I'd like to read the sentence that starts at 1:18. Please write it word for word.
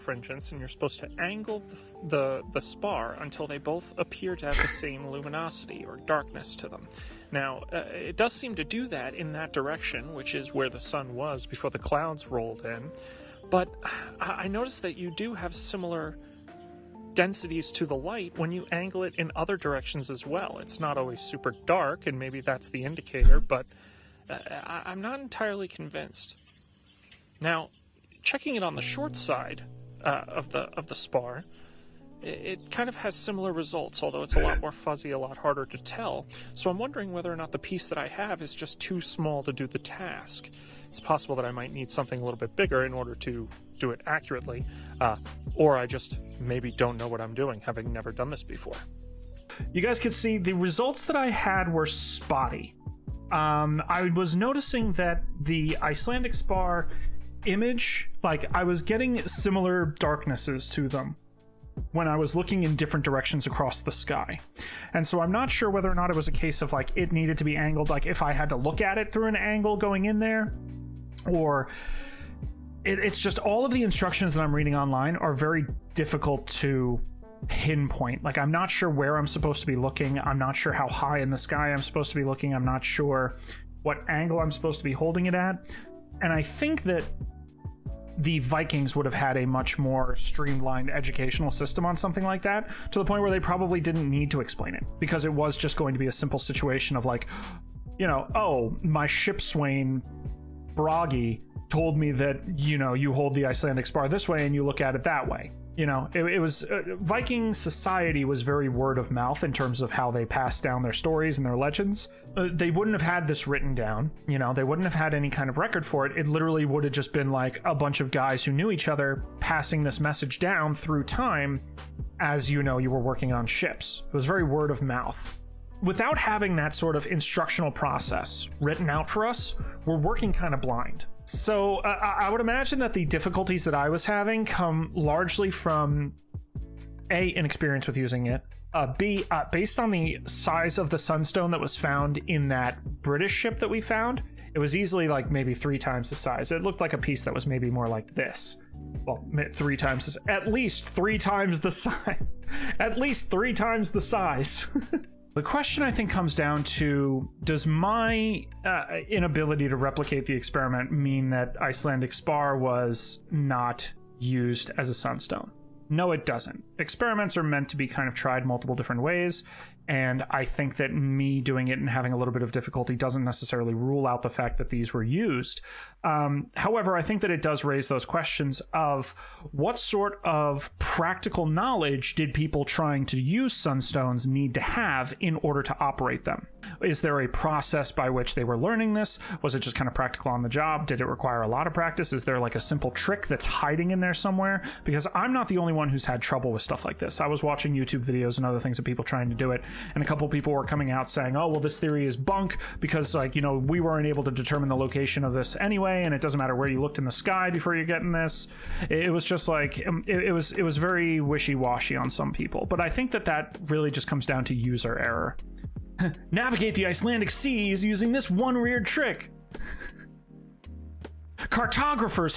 Like, I'm not sure where I'm supposed to be looking.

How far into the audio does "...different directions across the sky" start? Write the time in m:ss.
1:02.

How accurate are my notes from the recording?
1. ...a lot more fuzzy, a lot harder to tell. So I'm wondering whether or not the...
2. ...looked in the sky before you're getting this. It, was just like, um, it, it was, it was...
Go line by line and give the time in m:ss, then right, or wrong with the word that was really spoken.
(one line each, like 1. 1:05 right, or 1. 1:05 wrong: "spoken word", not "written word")
1. 0:34 right
2. 3:26 right.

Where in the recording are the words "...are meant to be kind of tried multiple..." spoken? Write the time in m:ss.
2:47.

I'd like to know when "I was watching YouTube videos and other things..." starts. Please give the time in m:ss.
3:17.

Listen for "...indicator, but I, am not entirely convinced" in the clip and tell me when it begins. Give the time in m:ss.
0:22.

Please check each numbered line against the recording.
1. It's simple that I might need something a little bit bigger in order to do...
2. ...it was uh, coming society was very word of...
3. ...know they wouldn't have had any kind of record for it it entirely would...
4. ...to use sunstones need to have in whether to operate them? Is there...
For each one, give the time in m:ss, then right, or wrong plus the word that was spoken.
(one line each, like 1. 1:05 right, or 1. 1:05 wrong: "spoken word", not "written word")
1. 0:40 wrong: "possible", not "simple"
2. 1:46 wrong: "viking", not "coming"
3. 1:54 wrong: "literally", not "entirely"
4. 3:03 wrong: "order", not "whether".